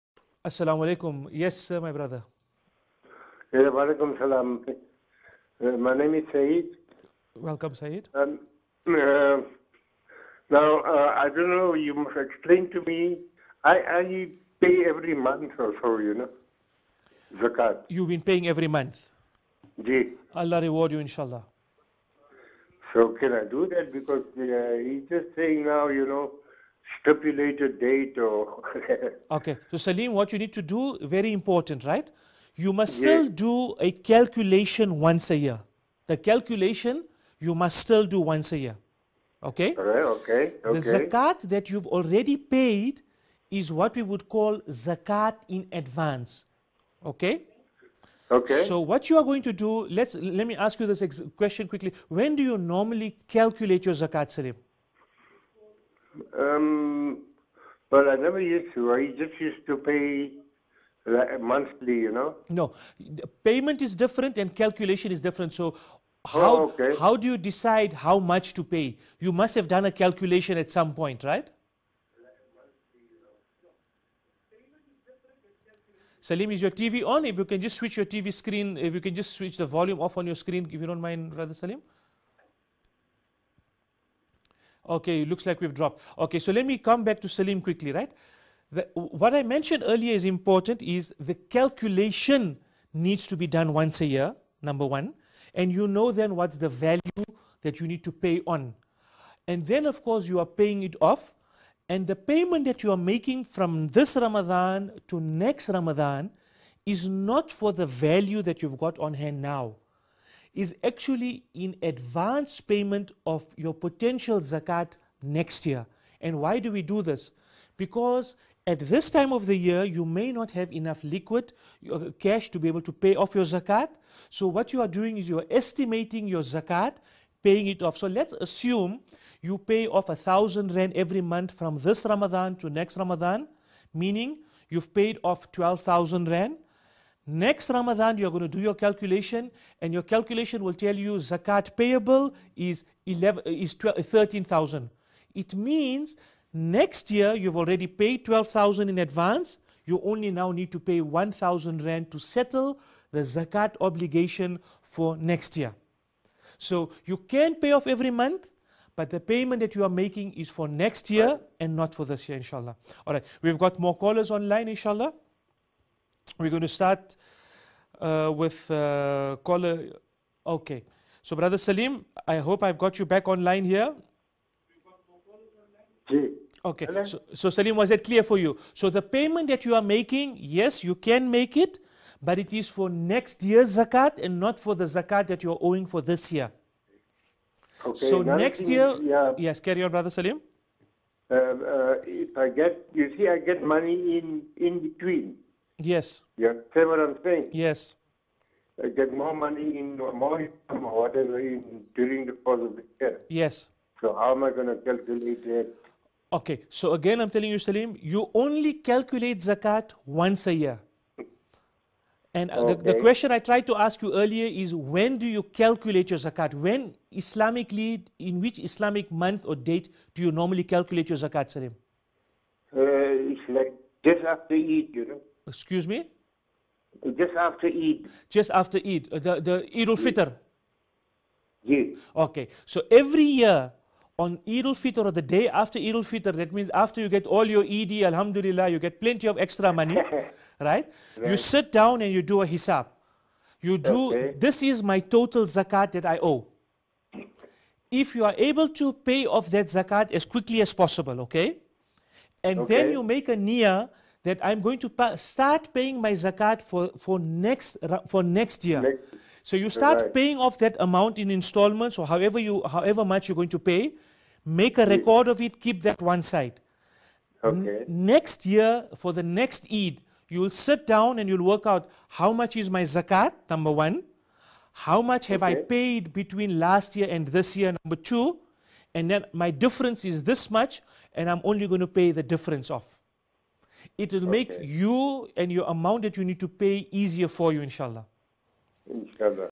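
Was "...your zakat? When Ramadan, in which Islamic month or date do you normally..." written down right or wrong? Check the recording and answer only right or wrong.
wrong.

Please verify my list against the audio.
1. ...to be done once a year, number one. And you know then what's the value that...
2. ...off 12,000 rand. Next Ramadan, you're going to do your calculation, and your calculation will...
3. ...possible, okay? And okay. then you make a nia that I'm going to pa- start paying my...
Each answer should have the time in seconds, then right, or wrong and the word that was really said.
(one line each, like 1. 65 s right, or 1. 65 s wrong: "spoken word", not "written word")
1. 93 s right
2. 135 s right
3. 250 s right.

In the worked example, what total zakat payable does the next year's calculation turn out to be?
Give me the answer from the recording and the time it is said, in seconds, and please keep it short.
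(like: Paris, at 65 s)
13,000, at 144 s.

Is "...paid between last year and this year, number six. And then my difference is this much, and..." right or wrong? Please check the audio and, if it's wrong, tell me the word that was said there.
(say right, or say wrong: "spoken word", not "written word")
wrong: "two", not "six".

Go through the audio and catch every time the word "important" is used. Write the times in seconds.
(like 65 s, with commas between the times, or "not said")
31 s, 90 s.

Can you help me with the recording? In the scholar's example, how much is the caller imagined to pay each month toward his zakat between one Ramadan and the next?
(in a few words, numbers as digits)
1,000 rand.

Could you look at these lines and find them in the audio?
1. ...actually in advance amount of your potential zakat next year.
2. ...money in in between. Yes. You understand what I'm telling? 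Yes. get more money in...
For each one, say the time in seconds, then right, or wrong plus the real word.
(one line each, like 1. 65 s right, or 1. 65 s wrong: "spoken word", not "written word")
1. 110 s wrong: "payment", not "amount"
2. 193 s wrong: "saying", not "telling".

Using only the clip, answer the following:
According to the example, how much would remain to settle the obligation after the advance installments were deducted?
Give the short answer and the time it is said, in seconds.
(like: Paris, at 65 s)
1,000 Rand, at 151 s.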